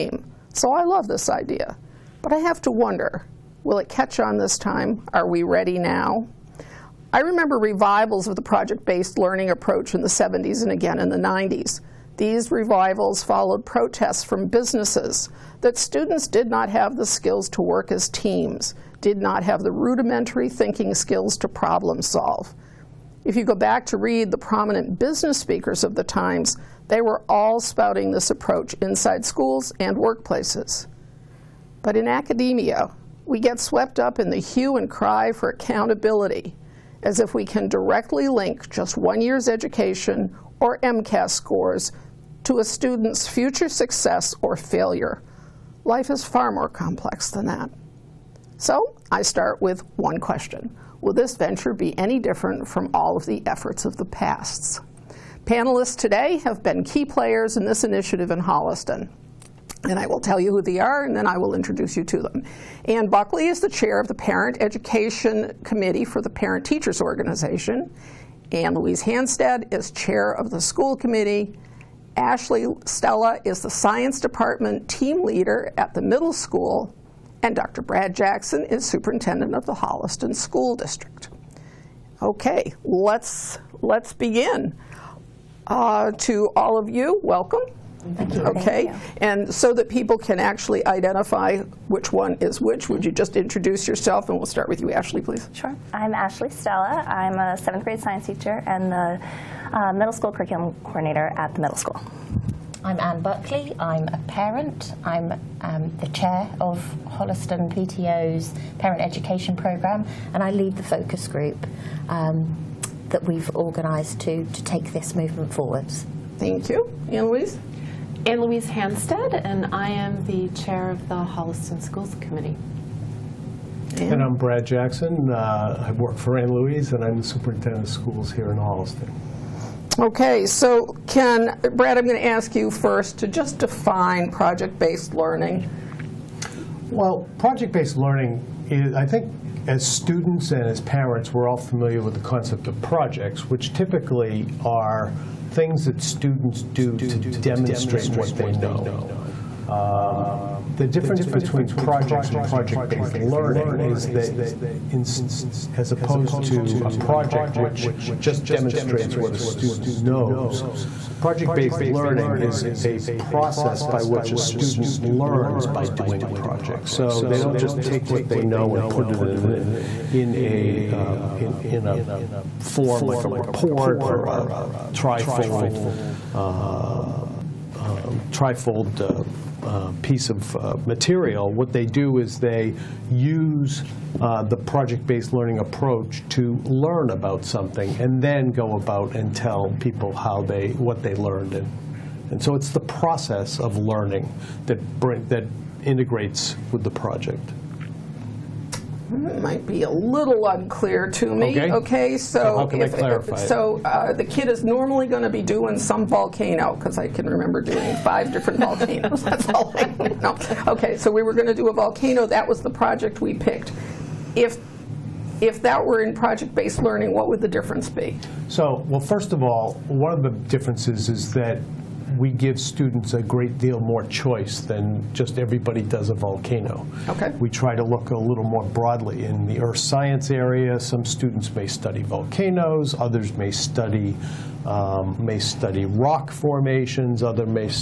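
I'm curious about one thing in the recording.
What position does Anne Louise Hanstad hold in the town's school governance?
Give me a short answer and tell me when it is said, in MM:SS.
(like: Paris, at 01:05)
chair of the school committee, at 01:09.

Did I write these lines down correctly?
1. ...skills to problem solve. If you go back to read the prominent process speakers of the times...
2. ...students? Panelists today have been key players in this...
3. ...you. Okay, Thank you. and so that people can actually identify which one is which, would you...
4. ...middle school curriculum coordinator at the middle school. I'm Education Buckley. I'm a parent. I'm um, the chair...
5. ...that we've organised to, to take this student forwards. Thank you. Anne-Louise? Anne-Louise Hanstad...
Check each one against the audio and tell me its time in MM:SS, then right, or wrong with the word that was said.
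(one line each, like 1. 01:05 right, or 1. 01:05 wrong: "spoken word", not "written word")
1. 00:20 wrong: "business", not "process"
2. 00:54 wrong: "pasts", not "students"
3. 01:28 right
4. 01:39 wrong: "Anne", not "Education"
5. 01:53 wrong: "movement", not "student".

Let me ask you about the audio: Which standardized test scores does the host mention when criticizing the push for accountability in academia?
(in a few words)
MCAS.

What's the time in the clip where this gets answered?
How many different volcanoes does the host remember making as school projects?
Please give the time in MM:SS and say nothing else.
03:27.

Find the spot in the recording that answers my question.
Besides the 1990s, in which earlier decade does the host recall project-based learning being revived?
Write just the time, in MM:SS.
00:10.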